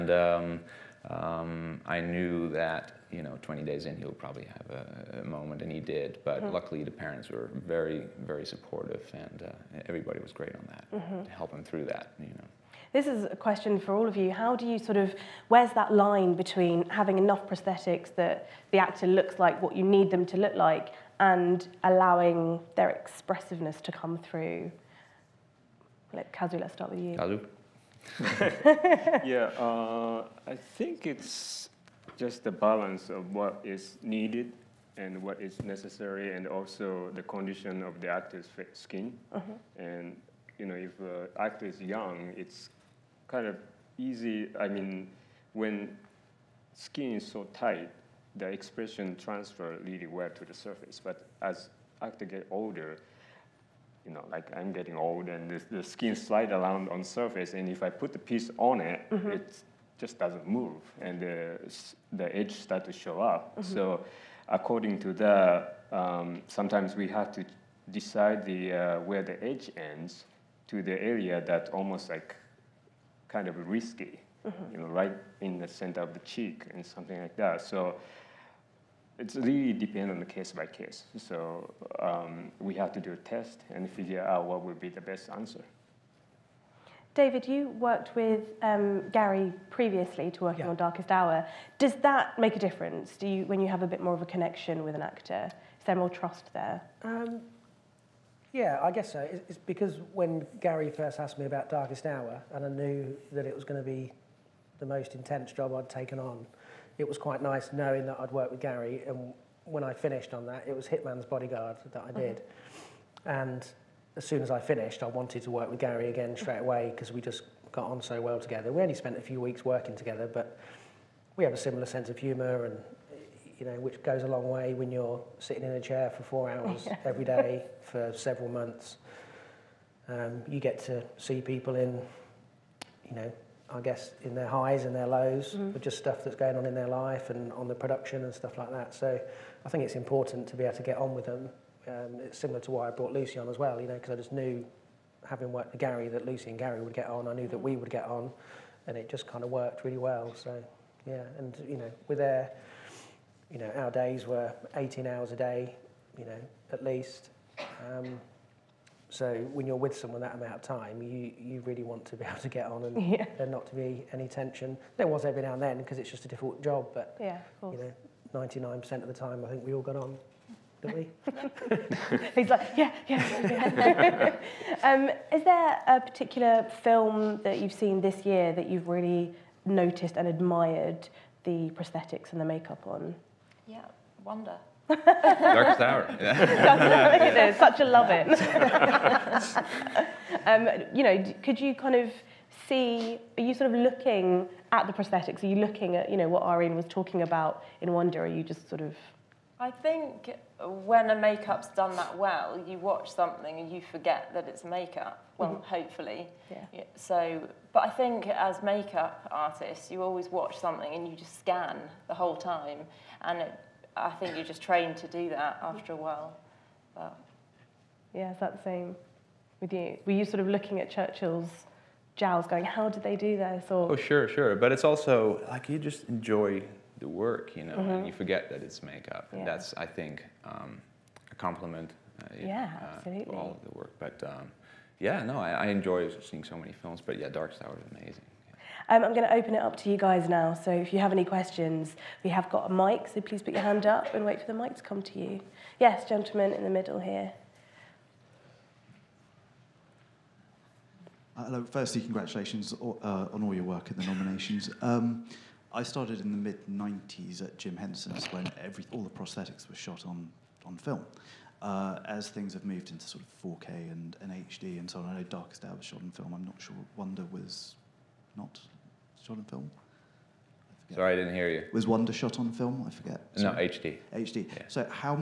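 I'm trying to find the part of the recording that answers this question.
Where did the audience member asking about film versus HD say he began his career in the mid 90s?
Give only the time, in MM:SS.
04:17.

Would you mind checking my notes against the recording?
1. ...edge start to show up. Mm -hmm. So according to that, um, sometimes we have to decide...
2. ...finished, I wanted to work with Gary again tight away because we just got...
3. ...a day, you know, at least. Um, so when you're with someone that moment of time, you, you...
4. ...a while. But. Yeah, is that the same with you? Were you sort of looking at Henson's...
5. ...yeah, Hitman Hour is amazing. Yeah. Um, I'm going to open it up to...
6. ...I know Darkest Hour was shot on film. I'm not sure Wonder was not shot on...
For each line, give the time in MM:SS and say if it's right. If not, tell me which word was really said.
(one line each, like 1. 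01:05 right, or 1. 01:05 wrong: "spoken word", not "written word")
1. 01:02 right
2. 01:54 wrong: "straight", not "tight"
3. 02:35 wrong: "amount", not "moment"
4. 03:35 wrong: "Churchill", not "Henson"
5. 03:57 wrong: "Darkest", not "Hitman"
6. 04:25 right.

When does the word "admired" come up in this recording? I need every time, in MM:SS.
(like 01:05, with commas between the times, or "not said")
03:00.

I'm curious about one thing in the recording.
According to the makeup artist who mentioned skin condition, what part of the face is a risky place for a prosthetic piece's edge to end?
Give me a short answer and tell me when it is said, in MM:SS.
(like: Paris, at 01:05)
Center of the cheek, at 01:15.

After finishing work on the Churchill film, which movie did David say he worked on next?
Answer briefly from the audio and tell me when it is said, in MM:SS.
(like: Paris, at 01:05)
Hitman's Bodyguard, at 01:50.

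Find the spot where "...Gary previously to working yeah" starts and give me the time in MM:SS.
01:29.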